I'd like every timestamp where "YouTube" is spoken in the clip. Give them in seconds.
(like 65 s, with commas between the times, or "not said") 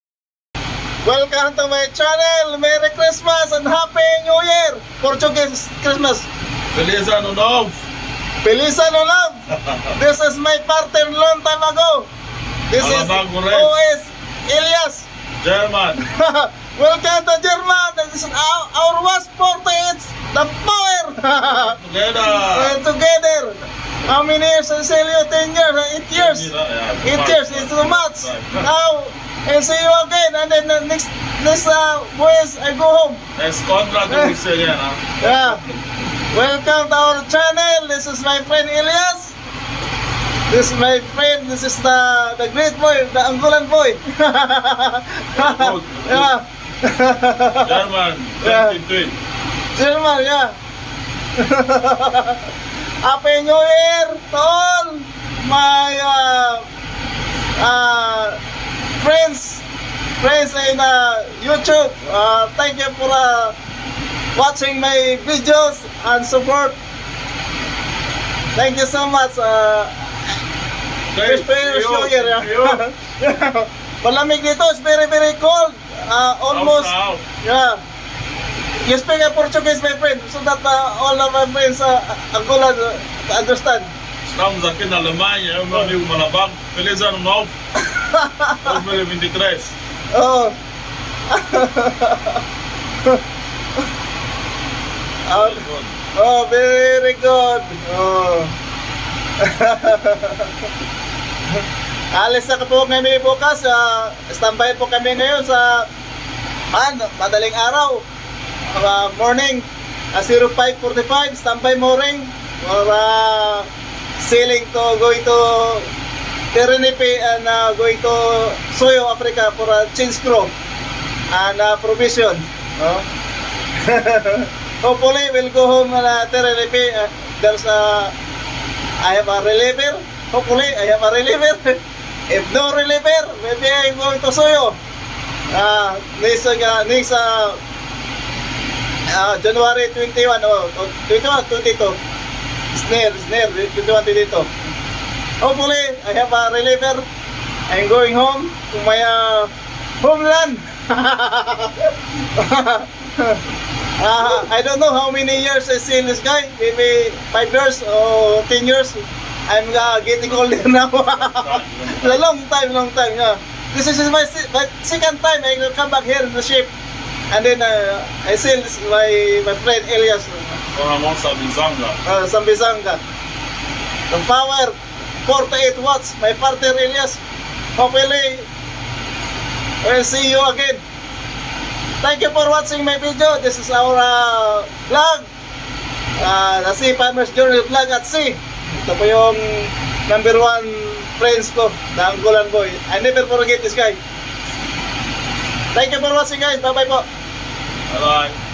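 61 s.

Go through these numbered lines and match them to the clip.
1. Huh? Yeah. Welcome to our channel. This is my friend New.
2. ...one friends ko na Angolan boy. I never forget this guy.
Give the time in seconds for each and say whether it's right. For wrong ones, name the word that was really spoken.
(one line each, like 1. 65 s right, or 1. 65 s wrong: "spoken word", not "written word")
1. 34 s wrong: "Elias", not "New"
2. 190 s right.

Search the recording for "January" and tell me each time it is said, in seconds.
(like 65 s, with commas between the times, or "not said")
139 s.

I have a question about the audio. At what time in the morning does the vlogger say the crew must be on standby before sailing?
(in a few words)
0545.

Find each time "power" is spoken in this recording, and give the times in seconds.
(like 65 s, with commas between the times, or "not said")
20 s, 174 s.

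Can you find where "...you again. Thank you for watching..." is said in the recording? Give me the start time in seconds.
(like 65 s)
180 s.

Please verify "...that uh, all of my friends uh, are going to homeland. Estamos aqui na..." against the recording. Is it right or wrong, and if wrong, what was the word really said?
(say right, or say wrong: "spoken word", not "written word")
wrong: "understand", not "homeland".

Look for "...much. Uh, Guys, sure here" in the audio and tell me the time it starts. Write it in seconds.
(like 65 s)
69 s.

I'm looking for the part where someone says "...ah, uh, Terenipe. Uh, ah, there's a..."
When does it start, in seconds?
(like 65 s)
126 s.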